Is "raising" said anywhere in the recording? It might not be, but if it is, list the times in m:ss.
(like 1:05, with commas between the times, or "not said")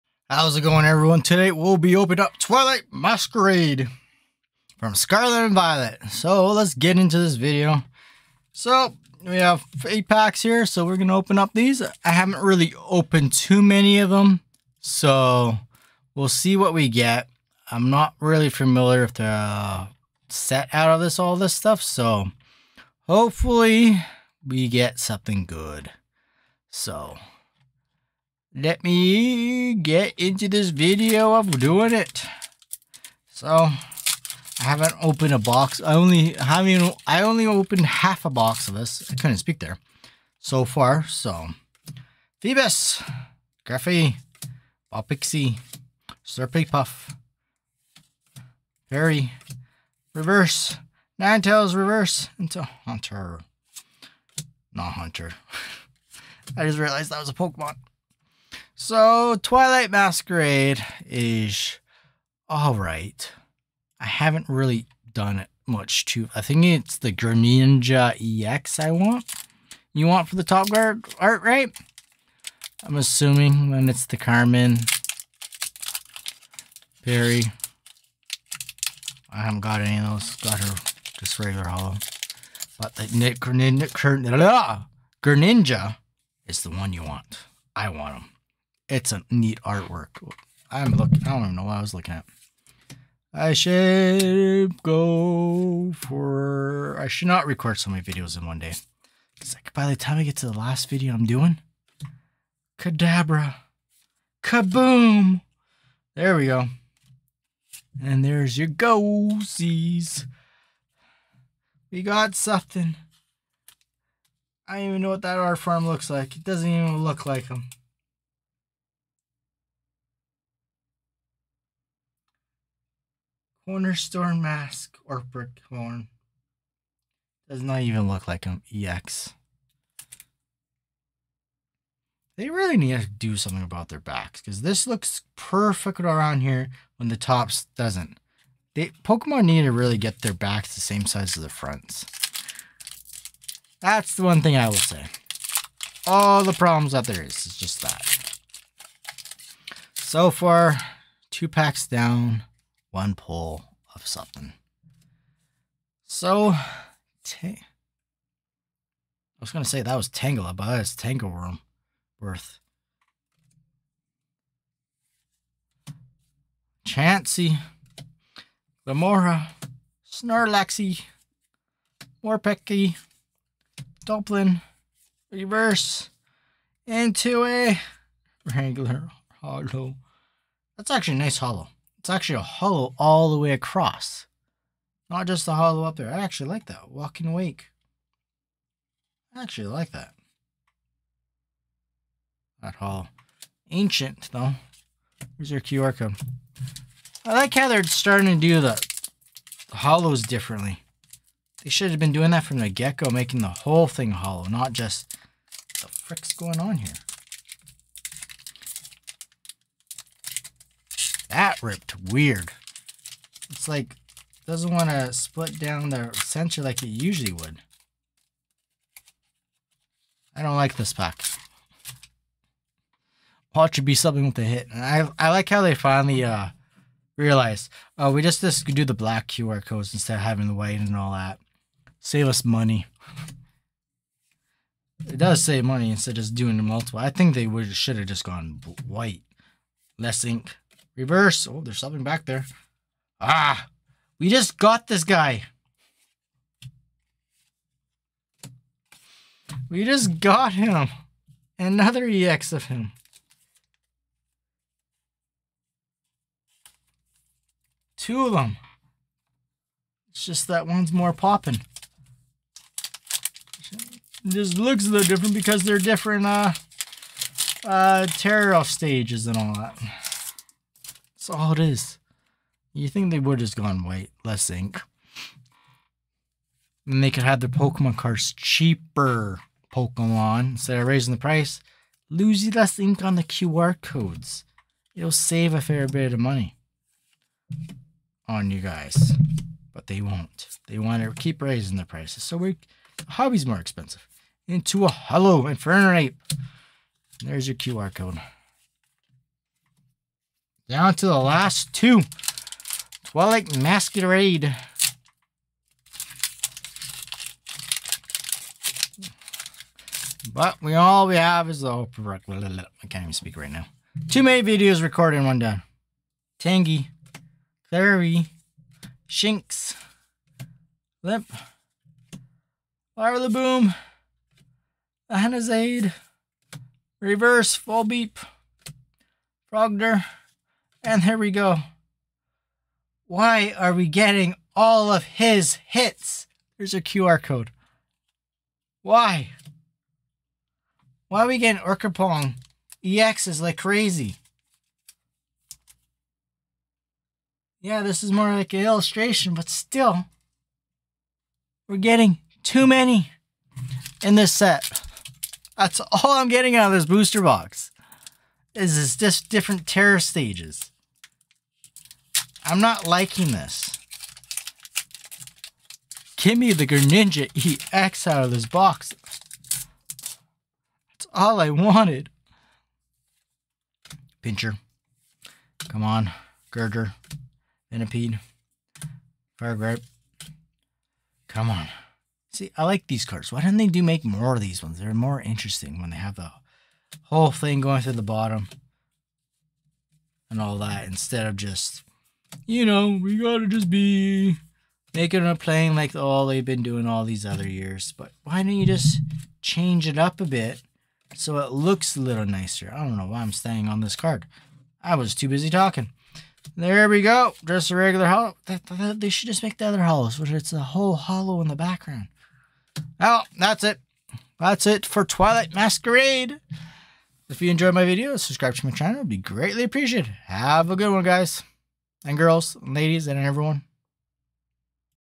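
4:40, 4:51.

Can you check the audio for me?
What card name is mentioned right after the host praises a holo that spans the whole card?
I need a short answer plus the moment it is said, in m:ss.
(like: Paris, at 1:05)
Walking Wake, at 3:06.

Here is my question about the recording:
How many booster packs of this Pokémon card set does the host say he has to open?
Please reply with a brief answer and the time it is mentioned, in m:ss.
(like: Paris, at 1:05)
8, at 0:09.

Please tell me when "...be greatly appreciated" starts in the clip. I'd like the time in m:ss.
6:59.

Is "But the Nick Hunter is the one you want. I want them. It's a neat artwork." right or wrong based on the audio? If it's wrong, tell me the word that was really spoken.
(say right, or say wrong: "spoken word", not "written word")
wrong: "Greninja", not "Hunter".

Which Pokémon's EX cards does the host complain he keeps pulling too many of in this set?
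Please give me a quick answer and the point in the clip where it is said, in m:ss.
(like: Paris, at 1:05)
Ogerpon, at 5:41.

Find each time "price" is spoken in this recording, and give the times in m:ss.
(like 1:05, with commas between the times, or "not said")
4:41, 4:51.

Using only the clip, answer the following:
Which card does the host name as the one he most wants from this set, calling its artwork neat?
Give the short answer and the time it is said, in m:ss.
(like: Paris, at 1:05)
Greninja EX, at 1:07.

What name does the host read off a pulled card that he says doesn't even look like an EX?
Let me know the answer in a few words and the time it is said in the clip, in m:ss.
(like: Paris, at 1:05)
Cornerstone Mask, at 2:03.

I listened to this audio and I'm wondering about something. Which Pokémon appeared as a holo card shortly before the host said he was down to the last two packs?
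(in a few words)
Infernape.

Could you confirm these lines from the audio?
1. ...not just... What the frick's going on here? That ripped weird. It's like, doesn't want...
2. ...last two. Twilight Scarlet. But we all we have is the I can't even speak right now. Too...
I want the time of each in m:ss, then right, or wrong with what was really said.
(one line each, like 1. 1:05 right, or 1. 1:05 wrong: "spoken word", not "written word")
1. 3:24 right
2. 5:01 wrong: "Masquerade", not "Scarlet".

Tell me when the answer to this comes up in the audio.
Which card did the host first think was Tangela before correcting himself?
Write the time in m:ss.
2:40.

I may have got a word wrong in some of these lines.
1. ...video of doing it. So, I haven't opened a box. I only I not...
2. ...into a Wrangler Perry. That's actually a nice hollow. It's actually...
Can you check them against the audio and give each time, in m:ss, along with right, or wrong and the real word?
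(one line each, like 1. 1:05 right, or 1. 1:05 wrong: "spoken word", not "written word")
1. 0:30 right
2. 2:56 wrong: "Hollow", not "Perry".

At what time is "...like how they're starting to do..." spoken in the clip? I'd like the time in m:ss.
3:17.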